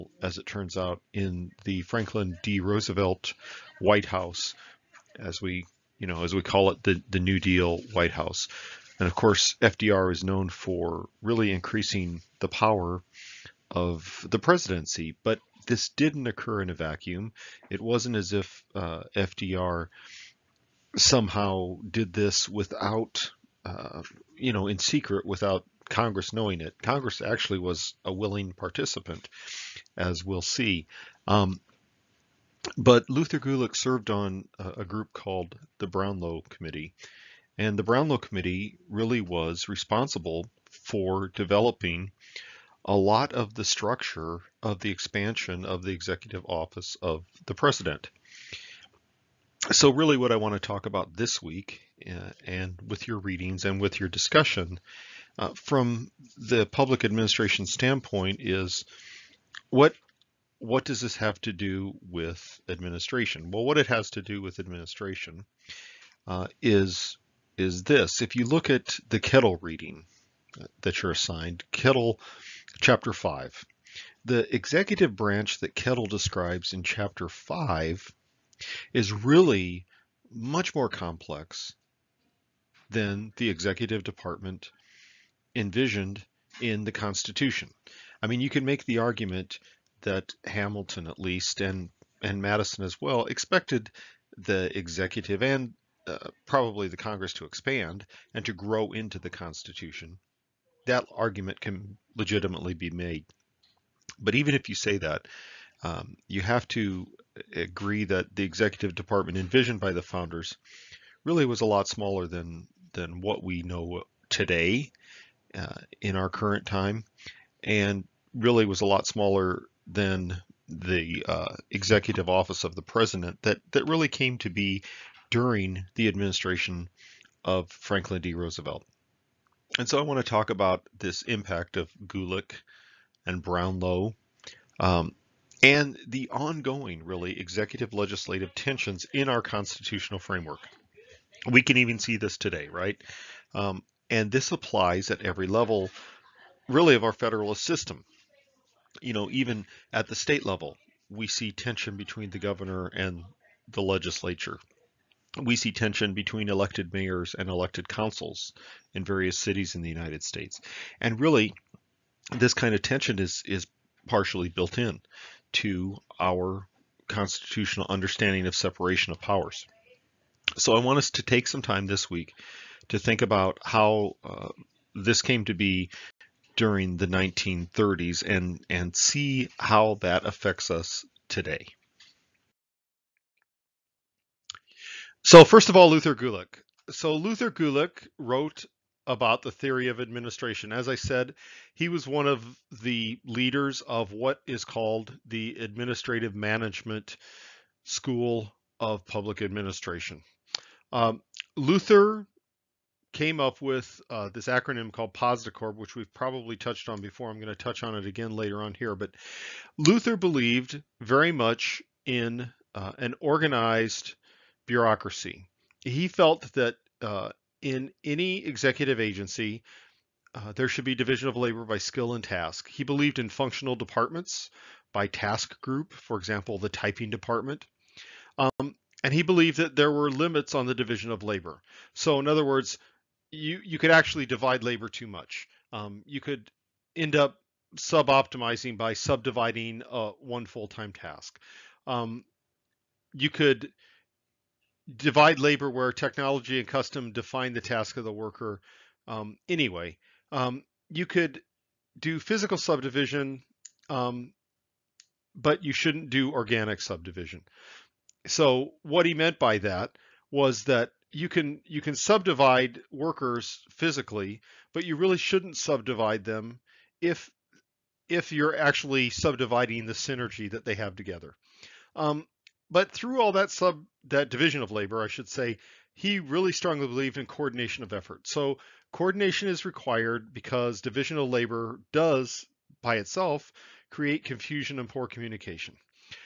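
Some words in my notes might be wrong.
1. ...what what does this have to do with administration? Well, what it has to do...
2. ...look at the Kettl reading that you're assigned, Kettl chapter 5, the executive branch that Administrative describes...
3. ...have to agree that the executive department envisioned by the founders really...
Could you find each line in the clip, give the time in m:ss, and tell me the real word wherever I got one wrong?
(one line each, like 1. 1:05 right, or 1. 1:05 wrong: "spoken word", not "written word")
1. 0:59 right
2. 1:08 wrong: "Kettl", not "Administrative"
3. 1:46 right.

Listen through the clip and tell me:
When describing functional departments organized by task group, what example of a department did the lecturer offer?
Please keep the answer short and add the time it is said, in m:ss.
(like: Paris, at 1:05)
The typing department, at 3:46.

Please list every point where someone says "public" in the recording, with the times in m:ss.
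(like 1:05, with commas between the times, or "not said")
0:56, 3:19.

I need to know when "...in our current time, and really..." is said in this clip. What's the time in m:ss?
1:56.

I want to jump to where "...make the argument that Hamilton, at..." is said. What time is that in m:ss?
1:28.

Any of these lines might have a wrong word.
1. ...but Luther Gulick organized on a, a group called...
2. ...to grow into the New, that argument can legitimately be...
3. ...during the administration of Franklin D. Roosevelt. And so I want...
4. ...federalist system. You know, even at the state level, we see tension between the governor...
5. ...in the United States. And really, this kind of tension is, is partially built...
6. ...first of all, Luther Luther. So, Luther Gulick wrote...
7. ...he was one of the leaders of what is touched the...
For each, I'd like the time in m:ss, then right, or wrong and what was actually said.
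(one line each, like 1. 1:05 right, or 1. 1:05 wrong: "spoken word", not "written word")
1. 0:32 wrong: "served", not "organized"
2. 1:38 wrong: "Constitution", not "New"
3. 2:05 right
4. 2:27 right
5. 2:39 right
6. 3:05 wrong: "Gulick", not "Luther"
7. 3:11 wrong: "called", not "touched".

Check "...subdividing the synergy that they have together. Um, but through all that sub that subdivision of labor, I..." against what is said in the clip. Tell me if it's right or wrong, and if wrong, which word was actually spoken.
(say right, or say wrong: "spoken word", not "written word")
wrong: "division", not "subdivision".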